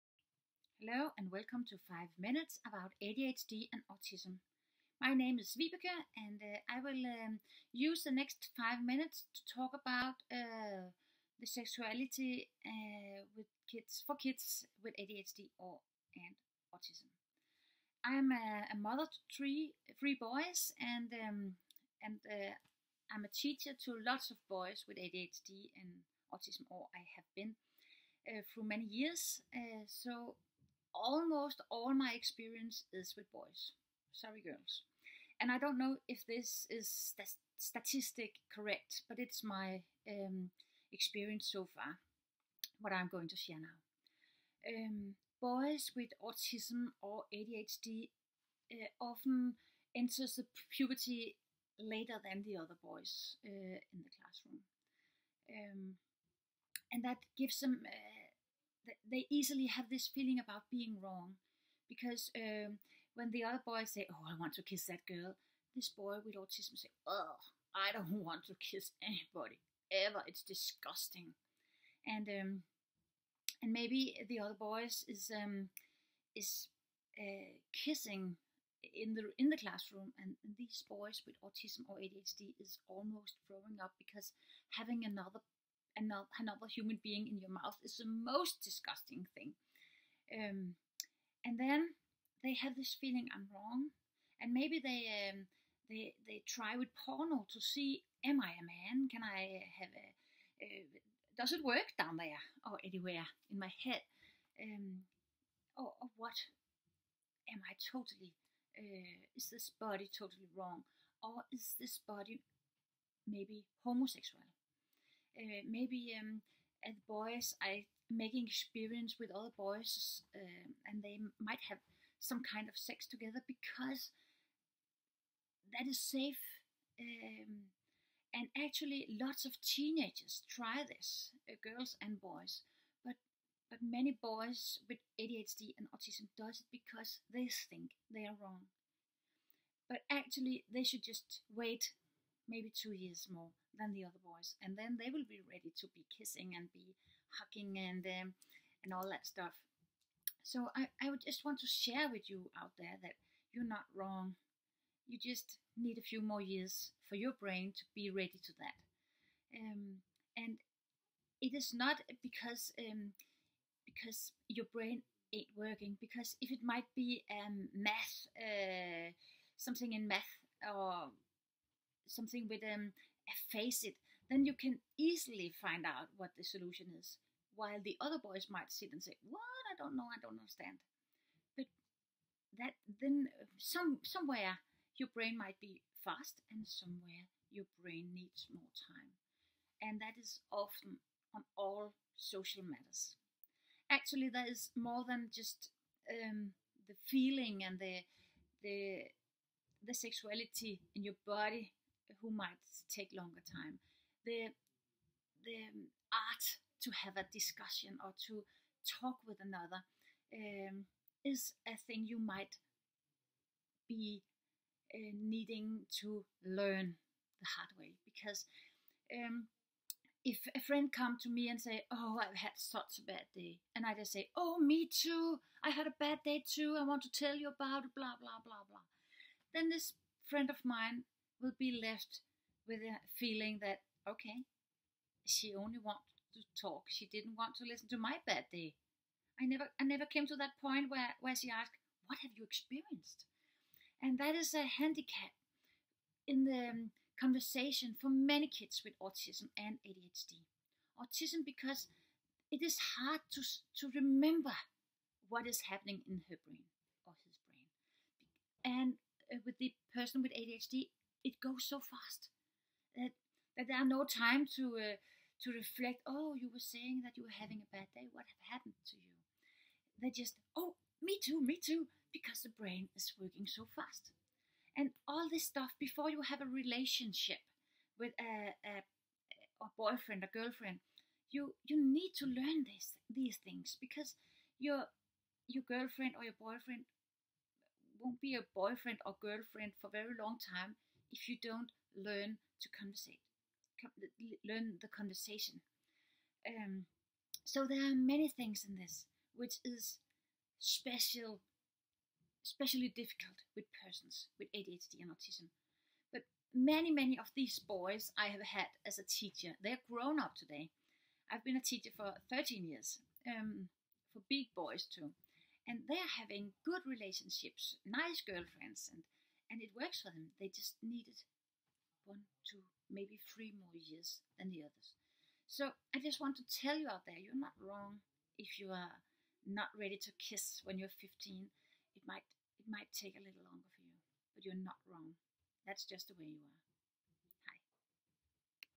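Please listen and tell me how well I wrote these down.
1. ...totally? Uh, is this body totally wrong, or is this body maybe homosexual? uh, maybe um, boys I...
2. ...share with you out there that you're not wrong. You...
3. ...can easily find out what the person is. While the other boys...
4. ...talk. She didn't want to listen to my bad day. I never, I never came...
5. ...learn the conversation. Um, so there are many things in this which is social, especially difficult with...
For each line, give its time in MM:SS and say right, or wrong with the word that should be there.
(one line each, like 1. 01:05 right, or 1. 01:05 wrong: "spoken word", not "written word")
1. 01:47 right
2. 02:31 right
3. 02:54 wrong: "solution", not "person"
4. 03:56 right
5. 04:54 wrong: "special", not "social".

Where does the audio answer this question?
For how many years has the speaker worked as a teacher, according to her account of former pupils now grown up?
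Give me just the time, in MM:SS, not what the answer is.
05:12.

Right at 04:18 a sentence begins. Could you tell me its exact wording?
And uh, with the person with ADHD, it goes so fast that that there are no time to uh, to reflect.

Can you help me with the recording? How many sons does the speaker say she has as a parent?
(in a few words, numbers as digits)
3.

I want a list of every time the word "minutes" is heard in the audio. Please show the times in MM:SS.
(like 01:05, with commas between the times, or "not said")
00:02, 00:08.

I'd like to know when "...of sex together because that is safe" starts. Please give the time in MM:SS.
02:02.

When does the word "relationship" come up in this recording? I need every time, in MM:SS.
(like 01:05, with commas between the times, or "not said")
04:36, 05:16.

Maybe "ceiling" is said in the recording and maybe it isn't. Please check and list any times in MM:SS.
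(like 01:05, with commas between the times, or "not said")
not said.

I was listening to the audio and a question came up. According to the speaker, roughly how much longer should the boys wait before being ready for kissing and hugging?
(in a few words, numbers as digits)
2 years.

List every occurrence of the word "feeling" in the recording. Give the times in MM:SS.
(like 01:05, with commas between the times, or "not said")
01:00, 01:32, 03:17, 03:53.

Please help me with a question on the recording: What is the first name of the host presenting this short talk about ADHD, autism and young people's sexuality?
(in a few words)
Vibeke.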